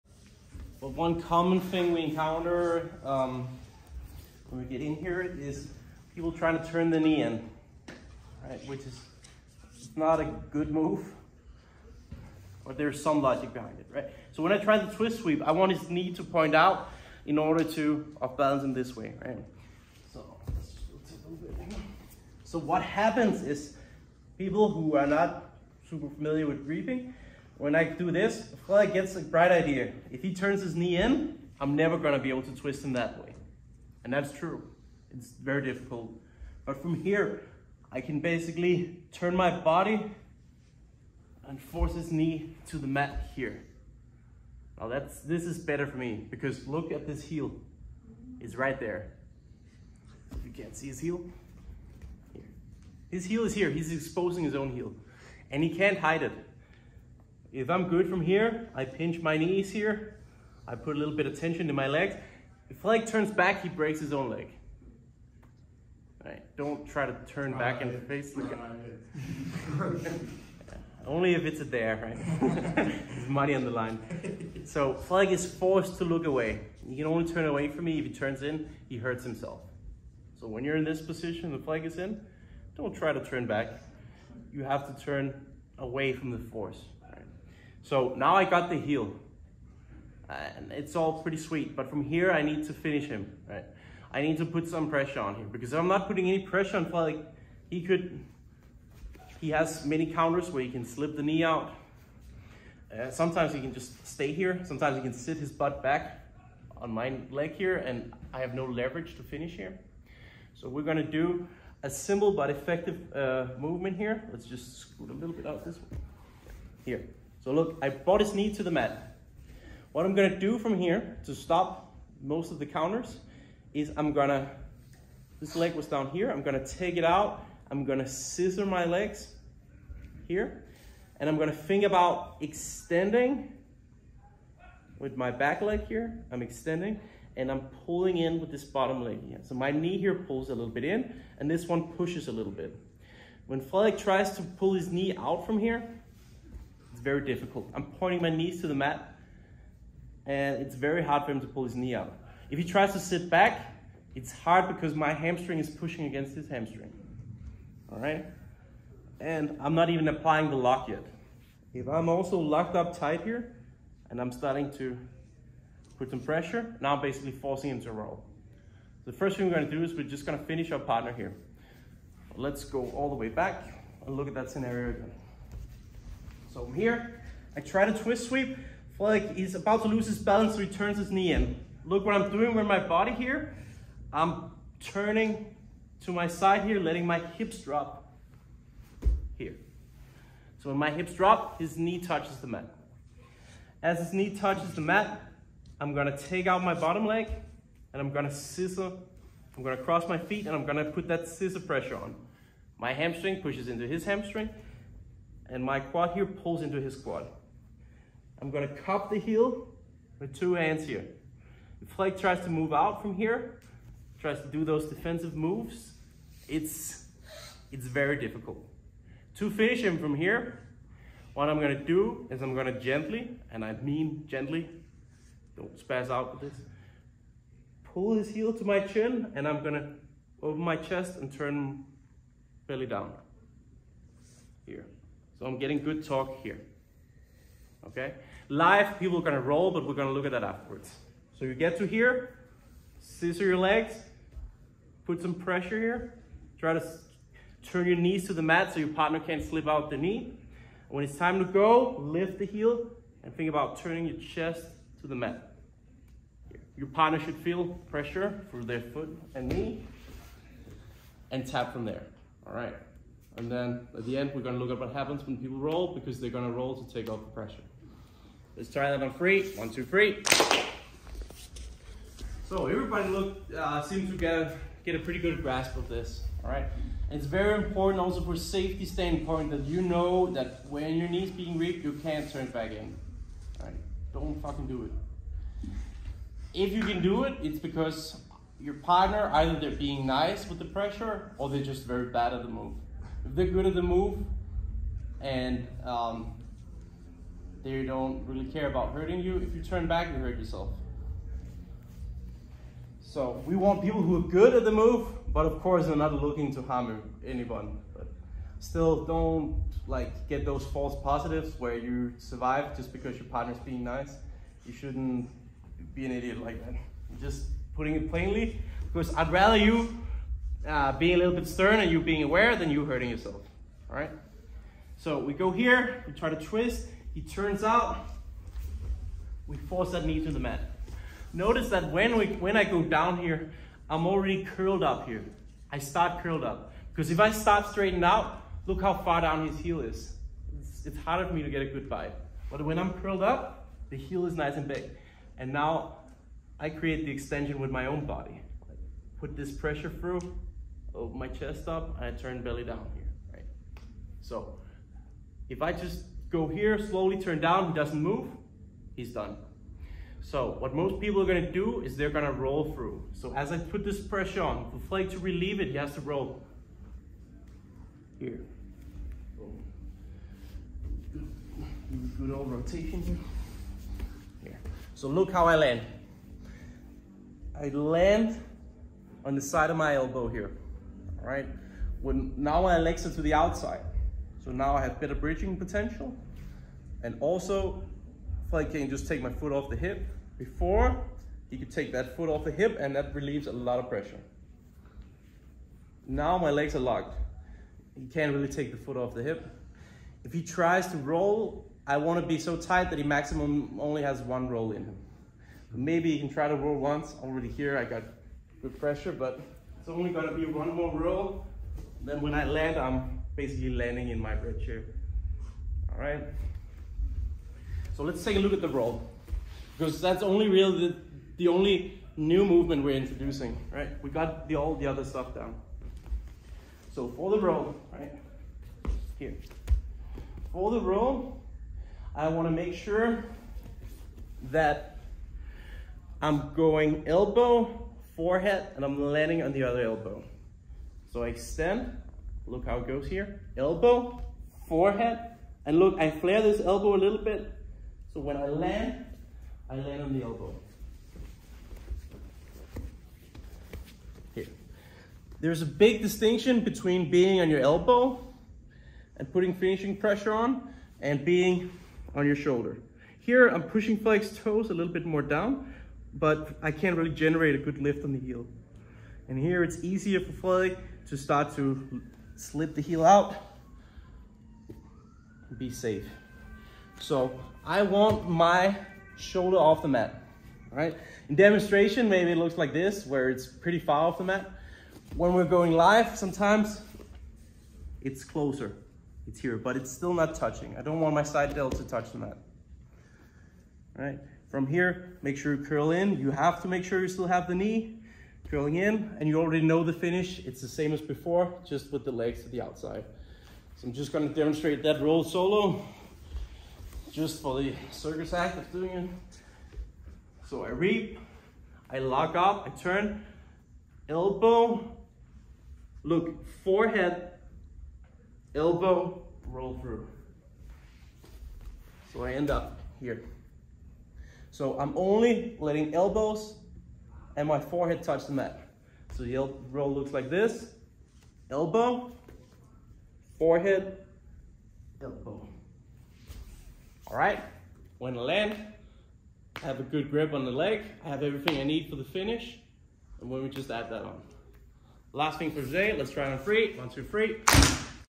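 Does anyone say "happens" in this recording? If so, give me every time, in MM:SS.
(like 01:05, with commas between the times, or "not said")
00:22, 04:24.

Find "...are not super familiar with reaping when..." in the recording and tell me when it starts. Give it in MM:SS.
00:24.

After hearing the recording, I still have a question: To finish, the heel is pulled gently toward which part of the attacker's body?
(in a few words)
Chin.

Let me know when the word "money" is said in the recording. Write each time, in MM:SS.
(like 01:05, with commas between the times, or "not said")
01:13.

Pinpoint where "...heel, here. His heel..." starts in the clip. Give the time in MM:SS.
00:50.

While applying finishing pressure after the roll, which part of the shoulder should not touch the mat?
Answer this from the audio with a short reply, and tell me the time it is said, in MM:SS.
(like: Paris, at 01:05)
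Side delt, at 08:11.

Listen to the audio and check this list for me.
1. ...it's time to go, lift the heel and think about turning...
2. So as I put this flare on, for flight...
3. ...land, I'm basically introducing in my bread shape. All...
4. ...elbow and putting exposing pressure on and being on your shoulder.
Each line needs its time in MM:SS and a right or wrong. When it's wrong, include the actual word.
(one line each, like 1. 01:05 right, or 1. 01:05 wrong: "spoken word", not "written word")
1. 04:11 right
2. 06:03 wrong: "pressure", not "flare"
3. 06:52 wrong: "landing", not "introducing"
4. 07:37 wrong: "finishing", not "exposing".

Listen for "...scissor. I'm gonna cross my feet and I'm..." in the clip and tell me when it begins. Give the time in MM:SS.
03:18.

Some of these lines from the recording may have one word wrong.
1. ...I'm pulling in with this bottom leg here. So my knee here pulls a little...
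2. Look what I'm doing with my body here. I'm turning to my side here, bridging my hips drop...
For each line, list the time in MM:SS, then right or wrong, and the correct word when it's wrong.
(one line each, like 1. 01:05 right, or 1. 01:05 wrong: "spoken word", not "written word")
1. 02:17 right
2. 03:01 wrong: "letting", not "bridging".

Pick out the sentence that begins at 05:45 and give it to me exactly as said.
And now I create the extension with my own body.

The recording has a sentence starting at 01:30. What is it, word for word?
And it's all pretty sweet, but from here I need to finish him, right?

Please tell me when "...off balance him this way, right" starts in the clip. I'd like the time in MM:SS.
00:18.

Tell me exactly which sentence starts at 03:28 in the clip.
I'm gonna cup the heel with two hands here.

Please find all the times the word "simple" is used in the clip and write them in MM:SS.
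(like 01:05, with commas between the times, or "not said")
01:51.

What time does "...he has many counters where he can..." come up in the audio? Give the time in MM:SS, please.
01:39.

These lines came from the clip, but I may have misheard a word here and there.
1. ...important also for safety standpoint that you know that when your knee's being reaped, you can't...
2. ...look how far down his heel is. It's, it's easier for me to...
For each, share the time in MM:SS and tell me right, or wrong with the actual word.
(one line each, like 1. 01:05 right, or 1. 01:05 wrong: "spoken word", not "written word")
1. 04:37 right
2. 05:38 wrong: "harder", not "easier".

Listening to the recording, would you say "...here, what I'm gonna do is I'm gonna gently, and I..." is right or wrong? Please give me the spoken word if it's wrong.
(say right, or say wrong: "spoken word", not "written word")
right.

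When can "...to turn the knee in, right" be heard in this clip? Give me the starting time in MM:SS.
00:06.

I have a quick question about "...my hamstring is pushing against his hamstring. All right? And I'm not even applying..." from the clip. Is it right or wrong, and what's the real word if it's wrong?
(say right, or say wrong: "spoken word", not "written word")
right.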